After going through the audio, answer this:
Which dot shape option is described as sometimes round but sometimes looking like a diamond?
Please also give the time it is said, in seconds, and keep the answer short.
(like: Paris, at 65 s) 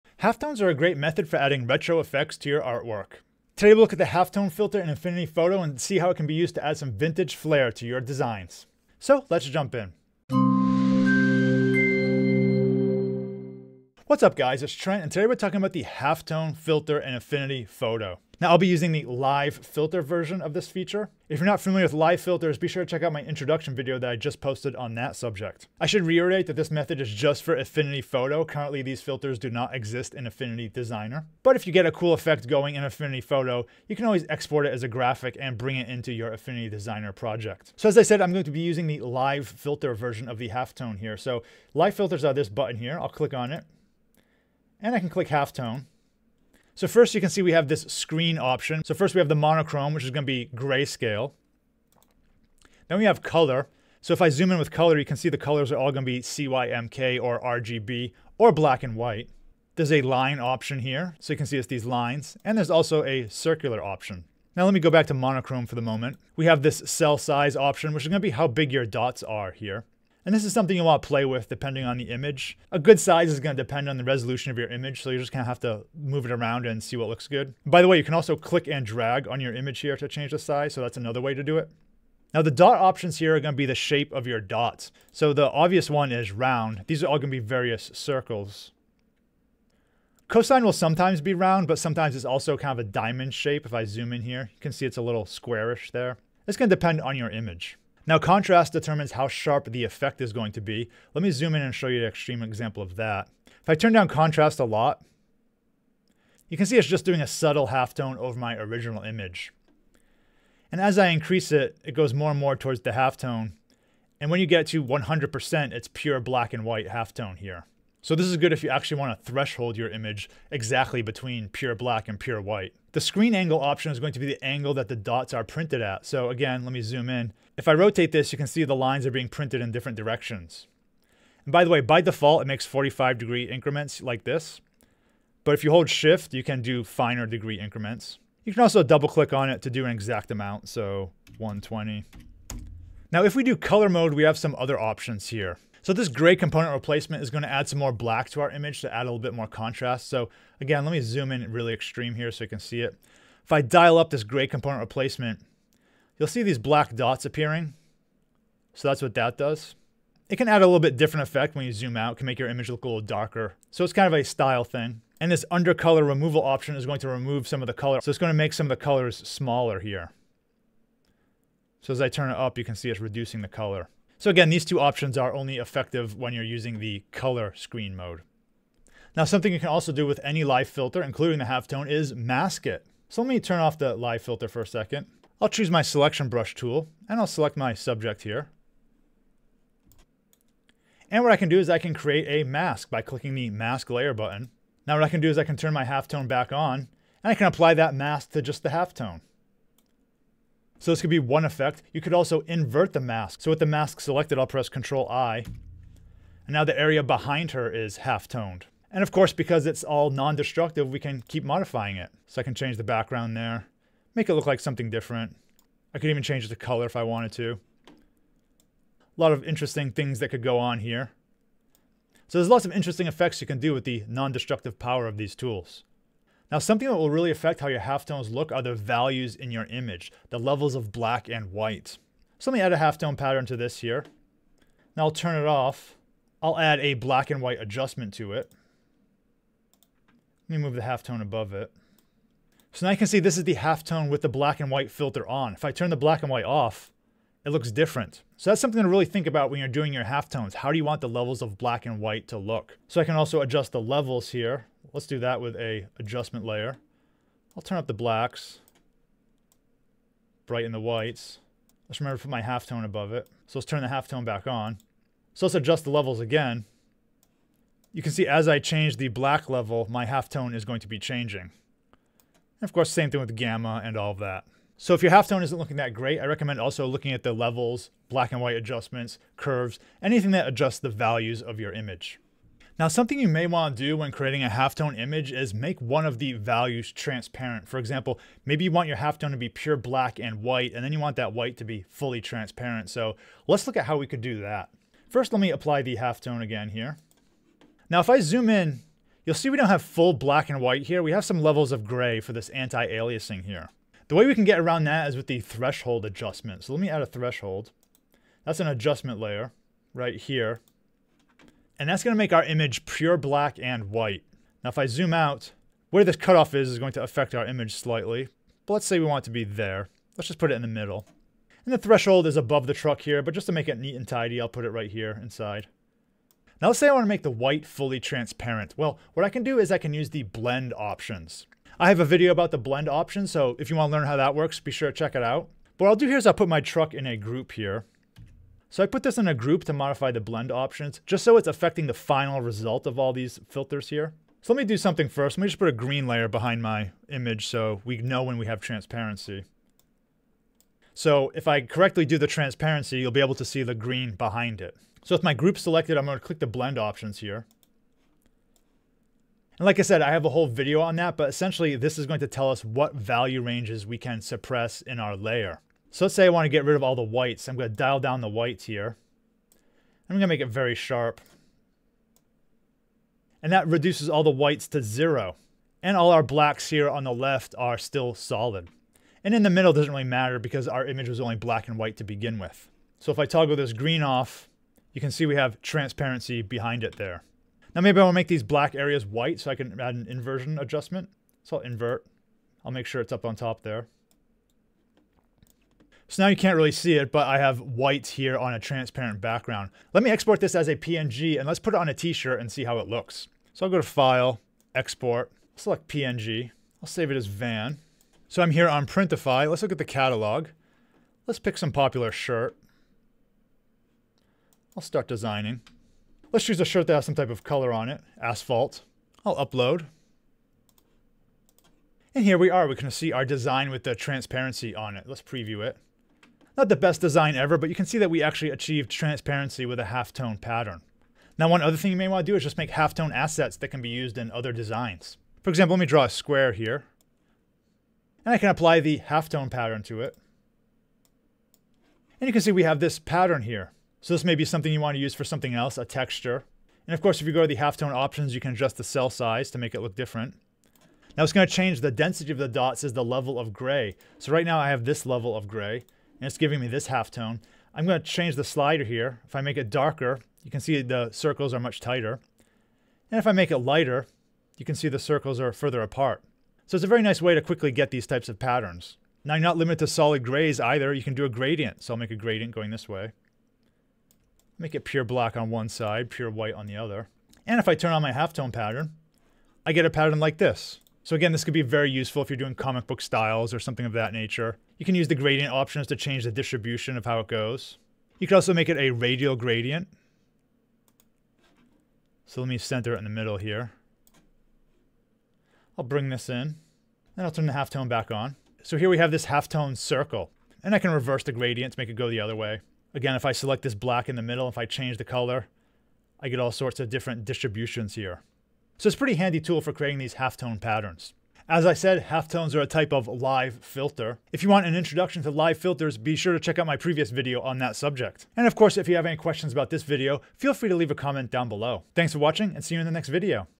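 Cosine, at 90 s.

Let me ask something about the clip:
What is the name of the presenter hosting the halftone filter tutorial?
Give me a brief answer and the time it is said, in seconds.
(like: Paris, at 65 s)
Trent, at 14 s.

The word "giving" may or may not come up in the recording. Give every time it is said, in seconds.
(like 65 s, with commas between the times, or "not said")
456 s.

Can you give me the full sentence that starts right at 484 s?
You can use the gradient options to change the distribution of how it goes.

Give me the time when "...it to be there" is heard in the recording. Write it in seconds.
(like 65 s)
319 s.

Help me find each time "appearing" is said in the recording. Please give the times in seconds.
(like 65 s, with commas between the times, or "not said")
157 s.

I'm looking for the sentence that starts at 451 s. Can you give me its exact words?
Now it's going to change the density of the dots as the level of gray.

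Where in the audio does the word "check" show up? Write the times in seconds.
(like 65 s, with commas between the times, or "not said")
22 s, 334 s, 516 s.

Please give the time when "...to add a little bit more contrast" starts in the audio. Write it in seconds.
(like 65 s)
148 s.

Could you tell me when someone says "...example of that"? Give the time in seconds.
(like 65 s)
102 s.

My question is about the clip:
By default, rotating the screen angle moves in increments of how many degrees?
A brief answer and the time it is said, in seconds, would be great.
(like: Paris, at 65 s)
45, at 132 s.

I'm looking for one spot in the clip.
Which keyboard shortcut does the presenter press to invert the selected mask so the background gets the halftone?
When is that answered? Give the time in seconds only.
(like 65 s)
204 s.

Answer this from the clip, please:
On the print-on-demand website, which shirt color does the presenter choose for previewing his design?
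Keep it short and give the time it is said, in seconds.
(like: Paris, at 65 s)
asphalt, at 418 s.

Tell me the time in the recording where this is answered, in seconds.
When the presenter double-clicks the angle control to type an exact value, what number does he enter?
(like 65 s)
141 s.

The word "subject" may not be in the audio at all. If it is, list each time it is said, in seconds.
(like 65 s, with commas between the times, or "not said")
25 s, 187 s, 517 s.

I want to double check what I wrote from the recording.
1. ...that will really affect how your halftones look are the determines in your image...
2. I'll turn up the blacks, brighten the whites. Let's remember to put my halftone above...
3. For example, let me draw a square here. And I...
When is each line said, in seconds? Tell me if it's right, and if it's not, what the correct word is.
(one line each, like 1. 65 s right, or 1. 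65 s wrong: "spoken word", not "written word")
1. 226 s wrong: "values", not "determines"
2. 257 s right
3. 435 s right.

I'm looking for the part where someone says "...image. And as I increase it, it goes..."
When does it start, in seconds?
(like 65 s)
109 s.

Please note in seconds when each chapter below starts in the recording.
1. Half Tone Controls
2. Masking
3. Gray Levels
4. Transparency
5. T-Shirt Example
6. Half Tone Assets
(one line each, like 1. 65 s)
1. 45 s
2. 183 s
3. 215 s
4. 282 s
5. 400 s
6. 431 s.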